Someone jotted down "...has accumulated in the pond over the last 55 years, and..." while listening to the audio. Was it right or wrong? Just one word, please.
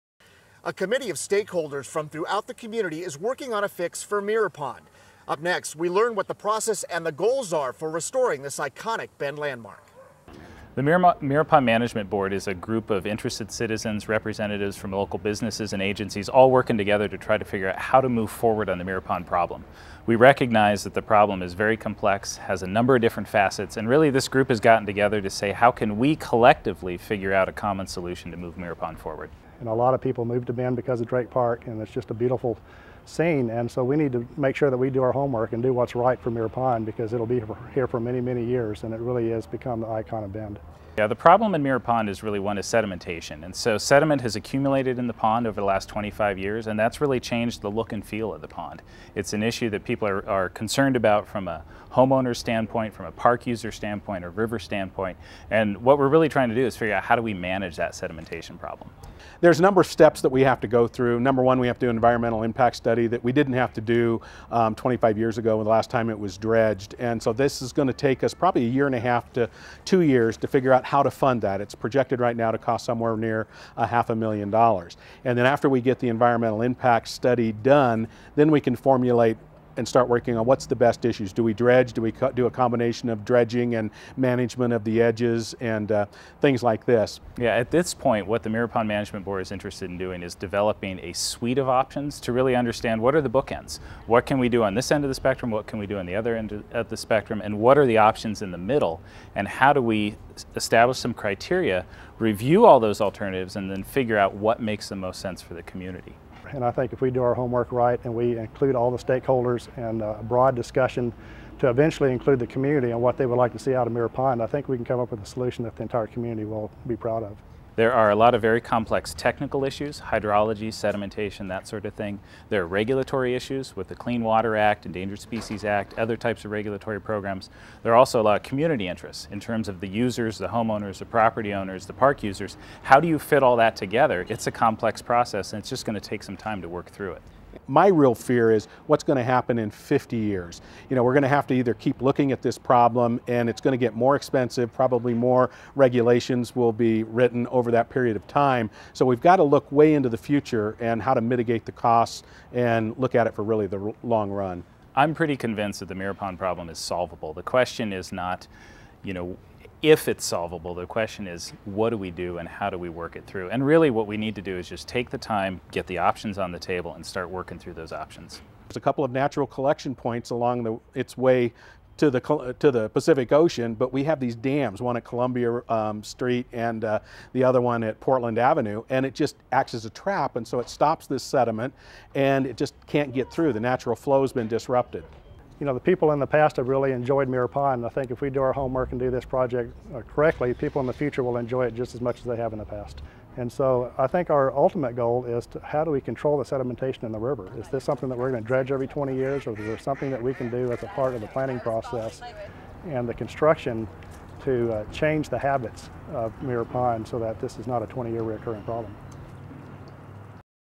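wrong.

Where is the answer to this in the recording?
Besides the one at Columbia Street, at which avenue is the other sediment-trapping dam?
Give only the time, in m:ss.
2:57.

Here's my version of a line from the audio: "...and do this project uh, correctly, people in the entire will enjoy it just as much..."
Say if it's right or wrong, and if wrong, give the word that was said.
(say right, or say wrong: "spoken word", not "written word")
wrong: "future", not "entire".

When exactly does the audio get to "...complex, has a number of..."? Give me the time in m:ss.
0:21.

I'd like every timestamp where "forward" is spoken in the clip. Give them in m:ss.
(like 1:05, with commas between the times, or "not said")
0:18, 0:28.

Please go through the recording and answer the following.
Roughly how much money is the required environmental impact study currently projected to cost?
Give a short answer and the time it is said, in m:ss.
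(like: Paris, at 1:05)
half a million dollars, at 1:13.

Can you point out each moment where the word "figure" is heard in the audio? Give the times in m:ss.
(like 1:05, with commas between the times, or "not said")
0:17, 0:26, 0:56, 1:10, 1:43.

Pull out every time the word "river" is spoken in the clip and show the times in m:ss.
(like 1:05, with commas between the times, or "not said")
0:54, 3:17.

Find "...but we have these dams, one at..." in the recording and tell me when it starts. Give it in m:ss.
2:53.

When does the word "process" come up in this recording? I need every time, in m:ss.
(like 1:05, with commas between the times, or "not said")
0:06, 2:15, 3:21.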